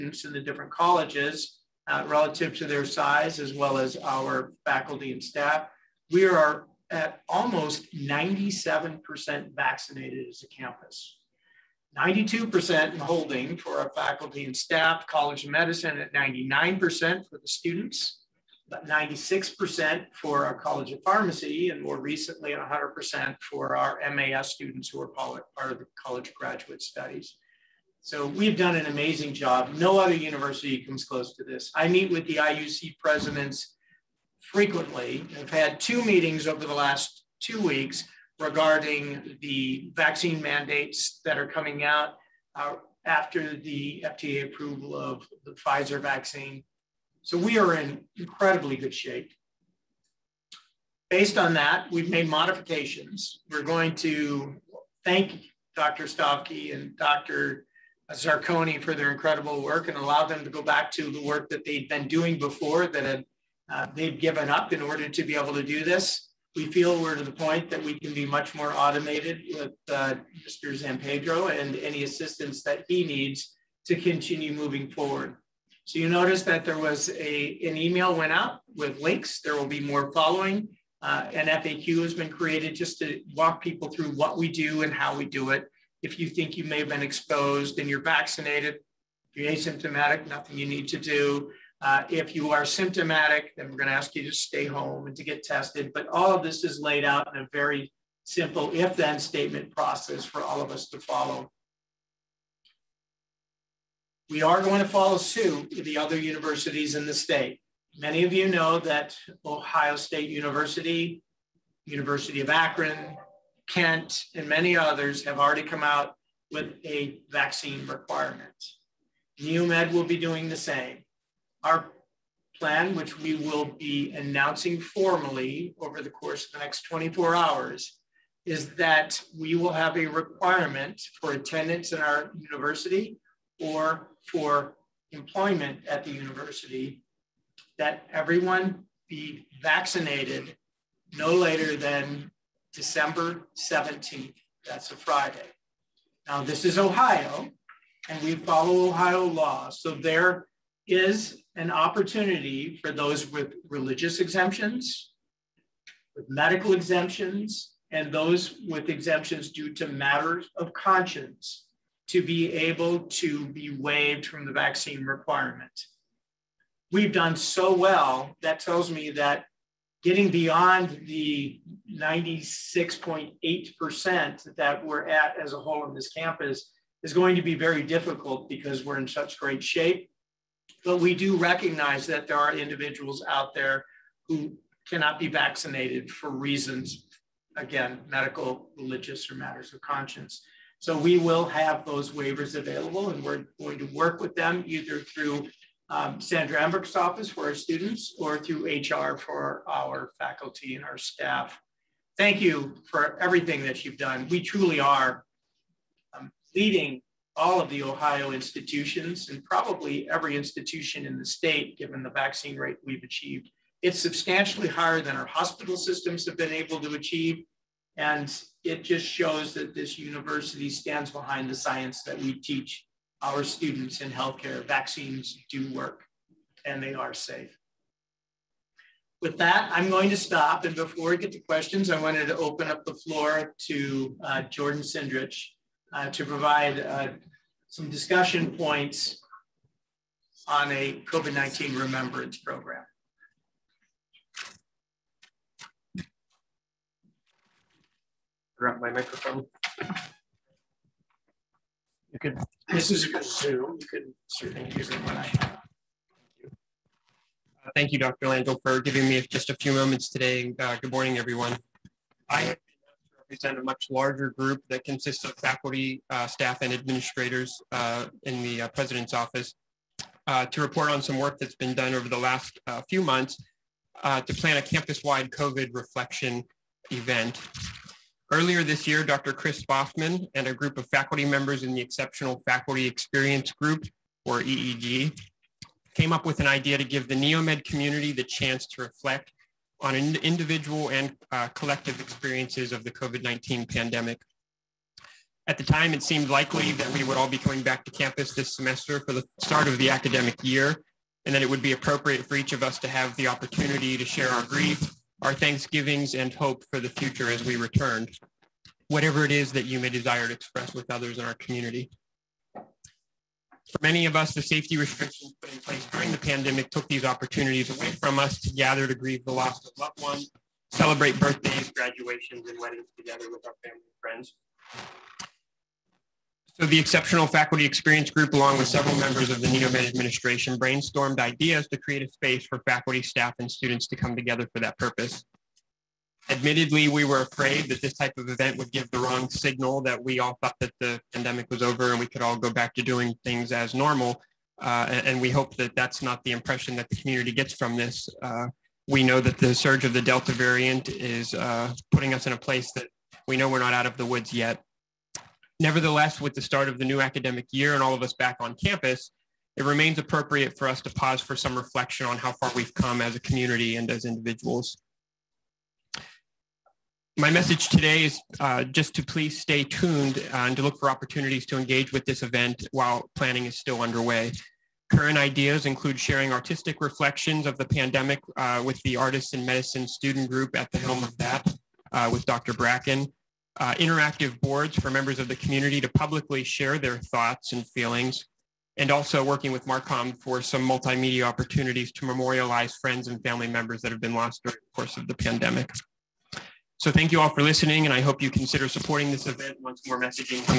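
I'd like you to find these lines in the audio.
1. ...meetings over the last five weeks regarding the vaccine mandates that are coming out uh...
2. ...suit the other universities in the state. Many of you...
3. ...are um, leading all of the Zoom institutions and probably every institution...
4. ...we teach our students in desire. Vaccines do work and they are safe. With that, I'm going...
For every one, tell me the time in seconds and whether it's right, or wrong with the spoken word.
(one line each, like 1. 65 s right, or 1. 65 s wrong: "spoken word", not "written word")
1. 36 s wrong: "two", not "five"
2. 105 s right
3. 204 s wrong: "Ohio", not "Zoom"
4. 222 s wrong: "healthcare", not "desire".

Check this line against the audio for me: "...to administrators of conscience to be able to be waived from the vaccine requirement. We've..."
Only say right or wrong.
wrong.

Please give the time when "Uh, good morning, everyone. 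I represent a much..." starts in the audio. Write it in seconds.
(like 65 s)
260 s.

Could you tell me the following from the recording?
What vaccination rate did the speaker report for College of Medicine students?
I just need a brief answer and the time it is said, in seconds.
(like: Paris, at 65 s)
99%, at 16 s.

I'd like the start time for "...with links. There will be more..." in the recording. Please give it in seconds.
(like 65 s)
78 s.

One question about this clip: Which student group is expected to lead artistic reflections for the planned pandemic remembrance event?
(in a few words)
Artists in Medicine.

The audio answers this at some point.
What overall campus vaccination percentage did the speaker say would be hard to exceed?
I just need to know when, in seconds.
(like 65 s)
171 s.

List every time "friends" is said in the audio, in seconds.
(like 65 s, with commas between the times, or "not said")
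324 s, 392 s.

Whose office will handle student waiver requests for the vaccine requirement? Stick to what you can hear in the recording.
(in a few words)
Sandra Emberg.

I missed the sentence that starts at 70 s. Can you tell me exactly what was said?
Zampedro and any assistance that he needs to continue moving forward.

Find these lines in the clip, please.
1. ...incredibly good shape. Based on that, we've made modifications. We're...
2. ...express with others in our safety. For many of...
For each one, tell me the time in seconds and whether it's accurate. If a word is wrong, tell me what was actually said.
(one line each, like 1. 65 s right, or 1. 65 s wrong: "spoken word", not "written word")
1. 48 s right
2. 310 s wrong: "community", not "safety".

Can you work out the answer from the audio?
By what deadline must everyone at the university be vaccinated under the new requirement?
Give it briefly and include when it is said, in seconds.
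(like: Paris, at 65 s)
December 17th, at 142 s.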